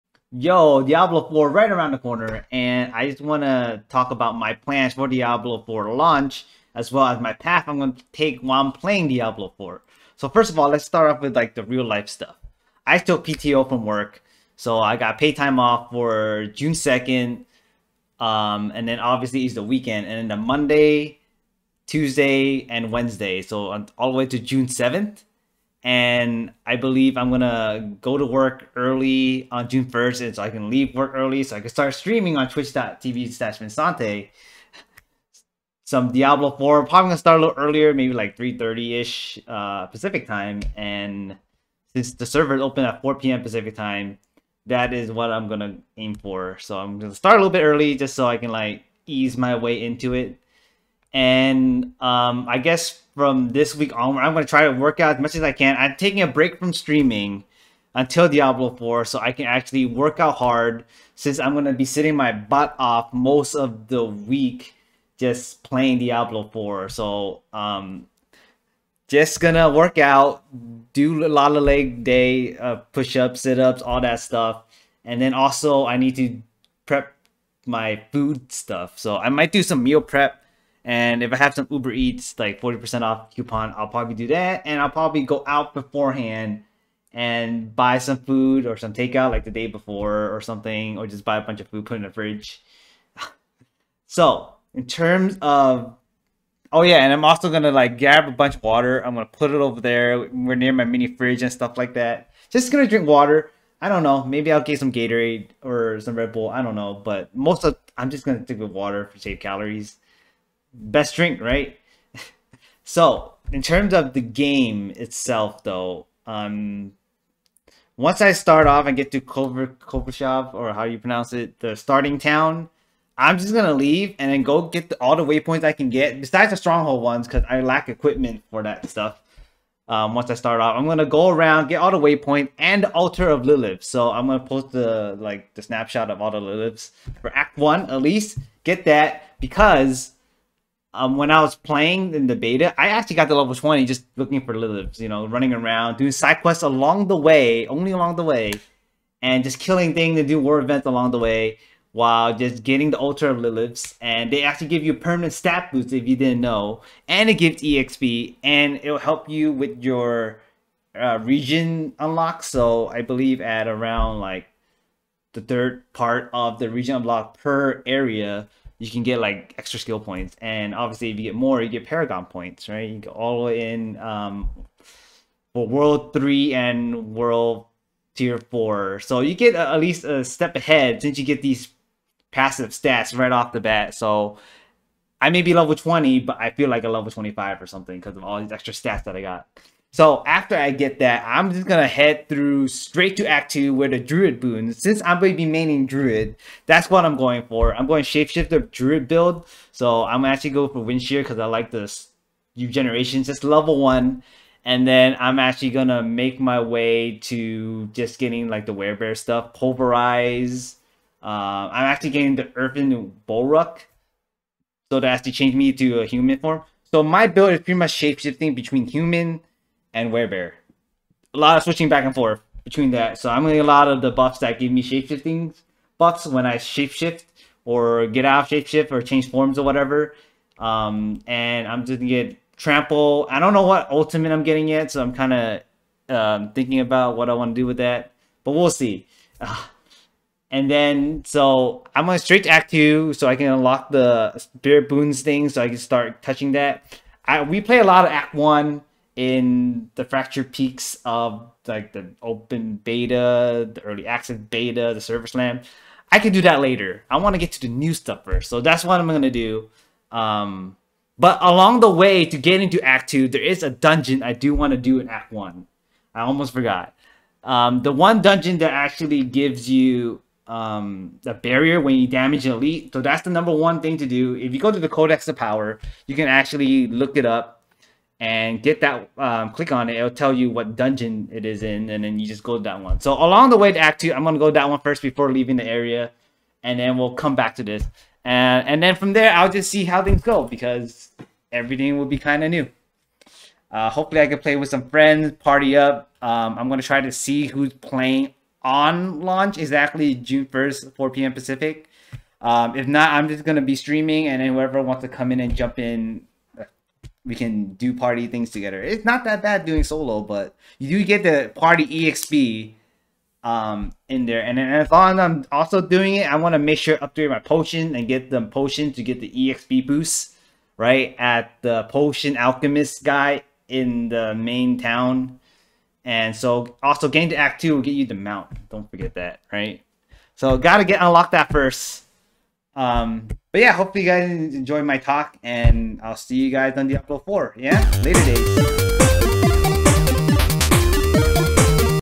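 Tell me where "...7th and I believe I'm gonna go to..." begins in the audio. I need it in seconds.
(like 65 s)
24 s.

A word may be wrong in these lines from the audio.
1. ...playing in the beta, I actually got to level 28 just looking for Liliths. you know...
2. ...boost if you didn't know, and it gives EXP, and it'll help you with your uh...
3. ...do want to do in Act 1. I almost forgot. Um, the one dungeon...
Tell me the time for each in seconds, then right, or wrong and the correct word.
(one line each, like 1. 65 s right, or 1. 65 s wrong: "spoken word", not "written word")
1. 141 s wrong: "20", not "28"
2. 155 s right
3. 264 s right.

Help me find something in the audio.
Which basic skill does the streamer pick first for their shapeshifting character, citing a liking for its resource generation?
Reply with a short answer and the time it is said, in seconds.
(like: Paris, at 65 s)
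Wind Shear, at 200 s.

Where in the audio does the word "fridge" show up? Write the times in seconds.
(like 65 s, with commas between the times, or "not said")
92 s, 101 s.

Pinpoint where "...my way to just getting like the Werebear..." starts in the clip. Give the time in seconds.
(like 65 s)
206 s.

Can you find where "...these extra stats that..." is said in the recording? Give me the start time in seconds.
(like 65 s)
188 s.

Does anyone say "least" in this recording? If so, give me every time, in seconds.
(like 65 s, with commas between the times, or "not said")
138 s, 179 s.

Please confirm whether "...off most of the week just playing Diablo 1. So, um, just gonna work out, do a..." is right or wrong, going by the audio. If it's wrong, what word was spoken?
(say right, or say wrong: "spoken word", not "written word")
wrong: "4", not "1".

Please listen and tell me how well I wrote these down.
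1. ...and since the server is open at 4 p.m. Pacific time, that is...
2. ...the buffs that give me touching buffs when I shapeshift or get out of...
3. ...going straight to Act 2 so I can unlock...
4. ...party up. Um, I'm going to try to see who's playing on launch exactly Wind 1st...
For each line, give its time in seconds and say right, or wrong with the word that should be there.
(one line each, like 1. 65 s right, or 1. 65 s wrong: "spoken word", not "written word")
1. 40 s right
2. 224 s wrong: "shapeshifting", not "touching"
3. 242 s right
4. 295 s wrong: "June", not "Wind".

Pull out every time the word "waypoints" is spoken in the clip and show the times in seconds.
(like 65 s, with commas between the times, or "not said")
125 s, 131 s.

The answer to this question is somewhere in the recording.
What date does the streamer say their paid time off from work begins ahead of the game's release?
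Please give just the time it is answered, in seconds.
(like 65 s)
16 s.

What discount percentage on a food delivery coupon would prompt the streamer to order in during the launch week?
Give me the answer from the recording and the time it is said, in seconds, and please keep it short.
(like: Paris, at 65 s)
40%, at 82 s.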